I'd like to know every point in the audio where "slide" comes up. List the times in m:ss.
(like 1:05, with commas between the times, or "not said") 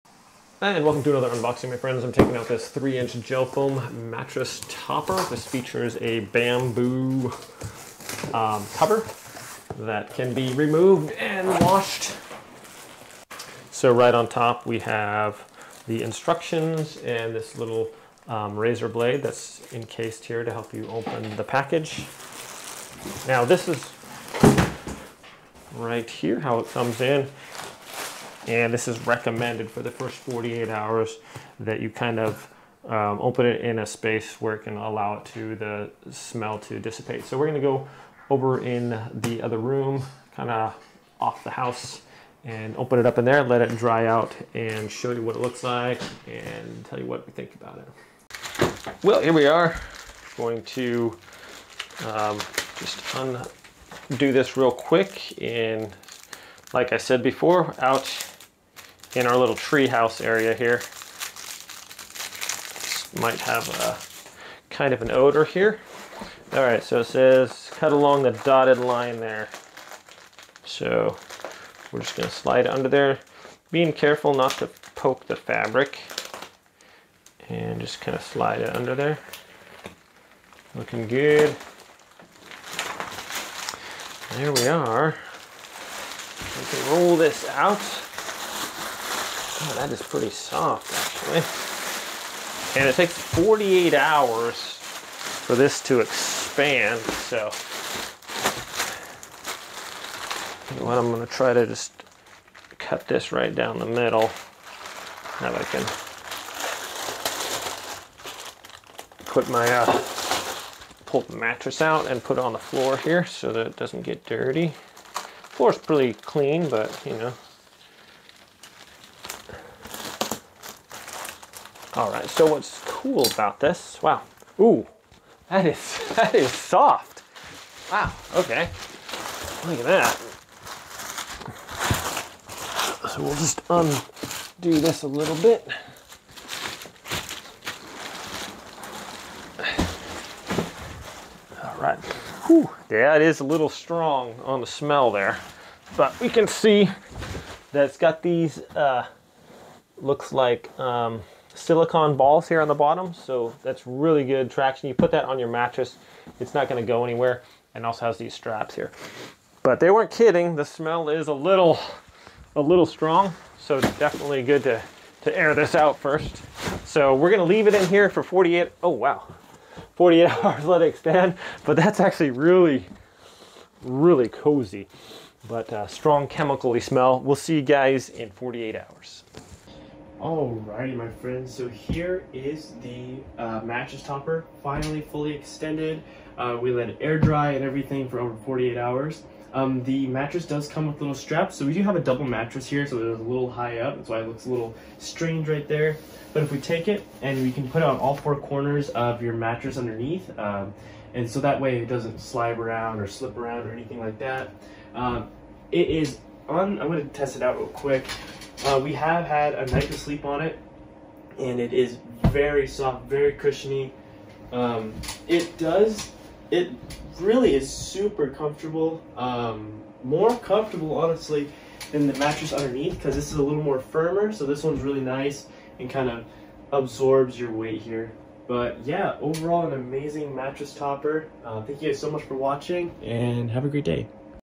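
1:12, 1:18, 3:22.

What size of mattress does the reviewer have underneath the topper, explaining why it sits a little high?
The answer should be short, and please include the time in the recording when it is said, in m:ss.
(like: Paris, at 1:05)
Double, at 3:11.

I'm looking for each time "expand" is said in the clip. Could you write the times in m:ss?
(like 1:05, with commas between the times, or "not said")
1:35, 2:50.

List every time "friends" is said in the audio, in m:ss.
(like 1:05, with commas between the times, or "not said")
0:01, 3:01.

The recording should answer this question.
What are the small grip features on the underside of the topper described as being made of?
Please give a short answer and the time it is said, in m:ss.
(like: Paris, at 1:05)
Silicone balls, at 2:31.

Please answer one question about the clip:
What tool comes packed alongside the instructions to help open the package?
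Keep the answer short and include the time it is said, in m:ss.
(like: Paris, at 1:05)
Razor blade, at 0:18.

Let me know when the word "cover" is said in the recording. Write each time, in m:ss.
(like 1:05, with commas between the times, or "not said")
0:08.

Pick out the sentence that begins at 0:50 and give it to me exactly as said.
Going to um, just undo this real quick and like I said before, out in our little treehouse area here.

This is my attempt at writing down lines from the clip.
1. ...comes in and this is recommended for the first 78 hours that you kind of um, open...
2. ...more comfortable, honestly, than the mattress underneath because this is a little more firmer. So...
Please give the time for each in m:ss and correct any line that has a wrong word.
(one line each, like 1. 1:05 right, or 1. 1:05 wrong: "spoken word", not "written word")
1. 0:26 wrong: "48", not "78"
2. 3:40 right.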